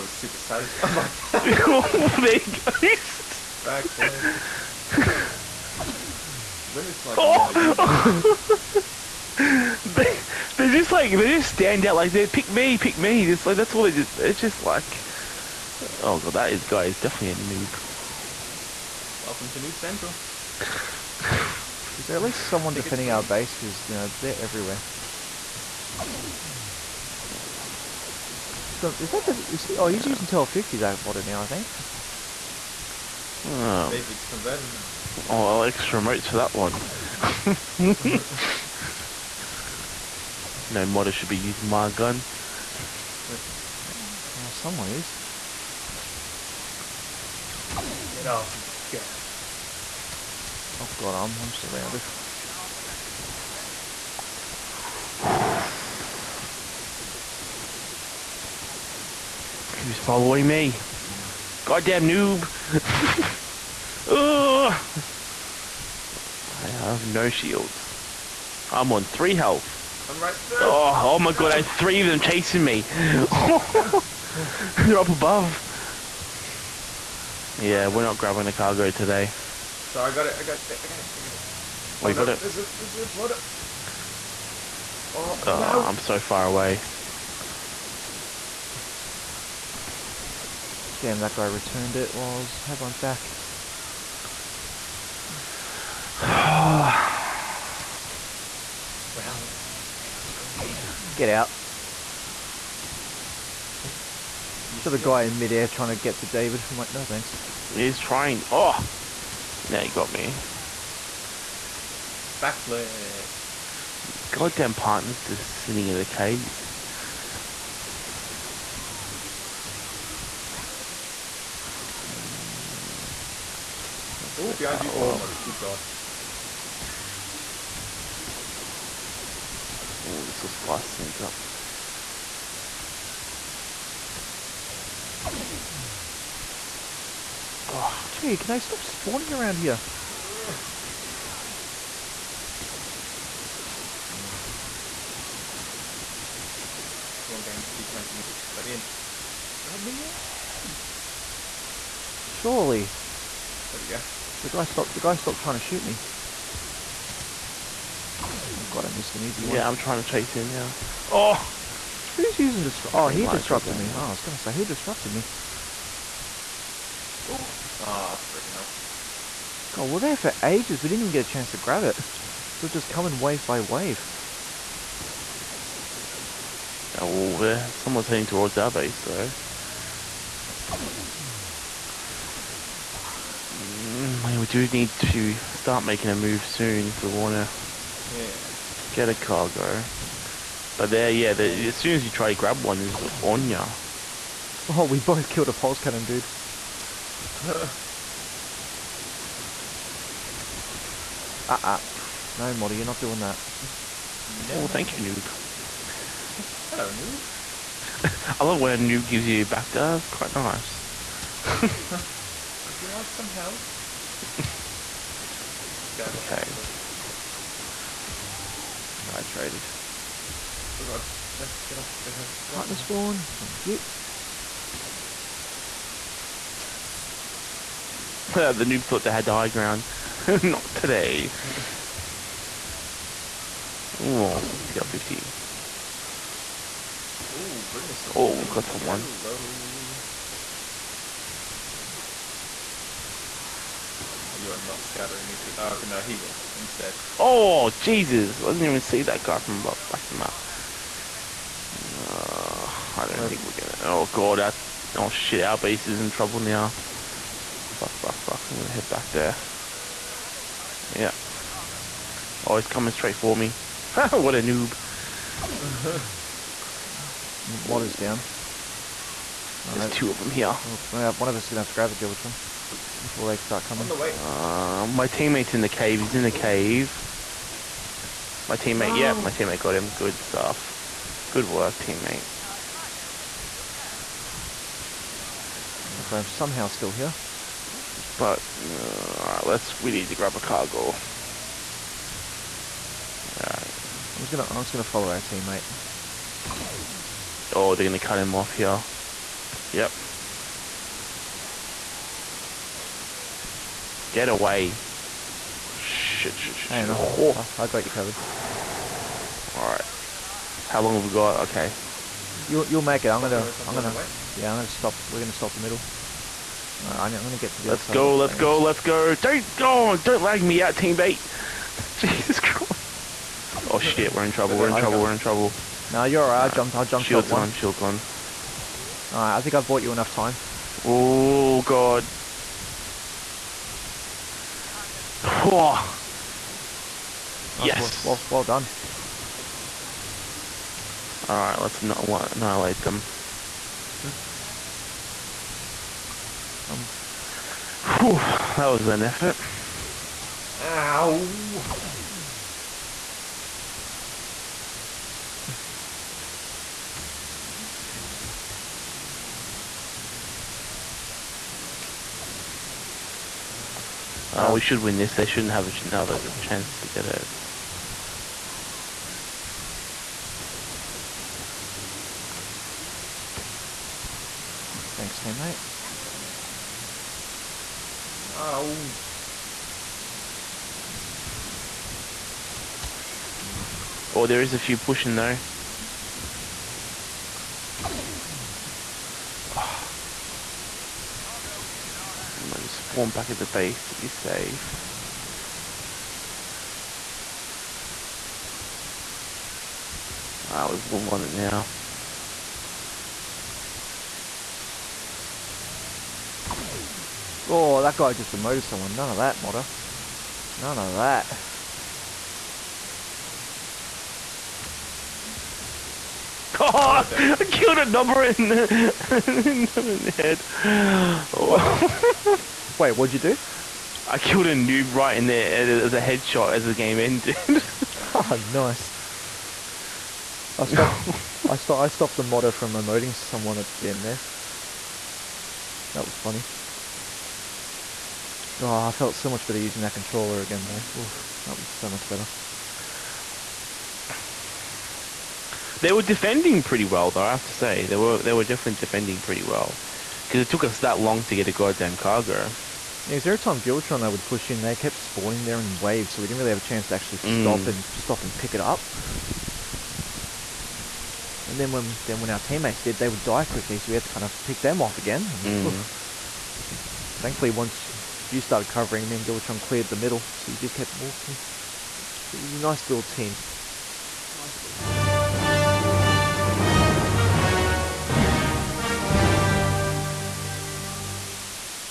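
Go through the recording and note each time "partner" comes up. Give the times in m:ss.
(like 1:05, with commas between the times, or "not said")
1:54, 3:42.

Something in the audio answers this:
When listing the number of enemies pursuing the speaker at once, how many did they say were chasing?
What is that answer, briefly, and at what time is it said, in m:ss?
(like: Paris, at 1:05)
3, at 1:11.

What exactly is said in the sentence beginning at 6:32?
I just spawn back at the base to be safe.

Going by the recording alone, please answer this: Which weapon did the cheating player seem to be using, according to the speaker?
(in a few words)
TL-50.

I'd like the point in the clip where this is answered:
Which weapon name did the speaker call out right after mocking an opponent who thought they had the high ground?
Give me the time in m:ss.
3:54.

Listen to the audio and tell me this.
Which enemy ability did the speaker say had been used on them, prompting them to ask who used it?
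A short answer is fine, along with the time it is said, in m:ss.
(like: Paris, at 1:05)
Disrupt, at 2:42.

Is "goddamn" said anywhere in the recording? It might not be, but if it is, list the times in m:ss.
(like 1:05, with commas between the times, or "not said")
1:01, 1:54, 7:31.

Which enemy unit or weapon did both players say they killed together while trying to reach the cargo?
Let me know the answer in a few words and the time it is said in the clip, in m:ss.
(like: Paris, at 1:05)
Pulse cannon, at 3:15.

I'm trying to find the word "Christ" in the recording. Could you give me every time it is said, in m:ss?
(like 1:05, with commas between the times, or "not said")
5:22.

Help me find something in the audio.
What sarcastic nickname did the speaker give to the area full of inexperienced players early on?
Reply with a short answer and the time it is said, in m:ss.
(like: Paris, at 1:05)
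Noob Central, at 0:19.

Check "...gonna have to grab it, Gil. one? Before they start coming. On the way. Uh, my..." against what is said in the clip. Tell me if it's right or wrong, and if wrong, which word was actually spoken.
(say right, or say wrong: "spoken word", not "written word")
right.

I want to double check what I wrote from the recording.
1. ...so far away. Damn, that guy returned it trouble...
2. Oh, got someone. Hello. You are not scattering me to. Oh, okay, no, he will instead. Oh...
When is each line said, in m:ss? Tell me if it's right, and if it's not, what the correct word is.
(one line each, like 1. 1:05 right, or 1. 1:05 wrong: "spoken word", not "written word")
1. 1:25 wrong: "while", not "trouble"
2. 3:58 right.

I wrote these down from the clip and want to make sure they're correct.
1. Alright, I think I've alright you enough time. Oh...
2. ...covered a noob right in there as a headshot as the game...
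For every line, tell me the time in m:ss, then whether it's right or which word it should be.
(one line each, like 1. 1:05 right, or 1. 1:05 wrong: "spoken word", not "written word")
1. 5:29 wrong: "bought", not "alright"
2. 7:04 wrong: "killed", not "covered".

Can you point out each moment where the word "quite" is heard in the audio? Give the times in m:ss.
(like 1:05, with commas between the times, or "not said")
3:30.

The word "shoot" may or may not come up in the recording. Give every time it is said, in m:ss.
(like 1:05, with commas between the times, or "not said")
2:35.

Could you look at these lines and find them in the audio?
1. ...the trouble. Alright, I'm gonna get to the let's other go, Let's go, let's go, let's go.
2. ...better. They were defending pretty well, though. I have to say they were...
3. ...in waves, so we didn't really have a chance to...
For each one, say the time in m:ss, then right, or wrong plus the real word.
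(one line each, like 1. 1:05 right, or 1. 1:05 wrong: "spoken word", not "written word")
1. 5:15 wrong: "middle", not "trouble"
2. 7:22 right
3. 7:35 right.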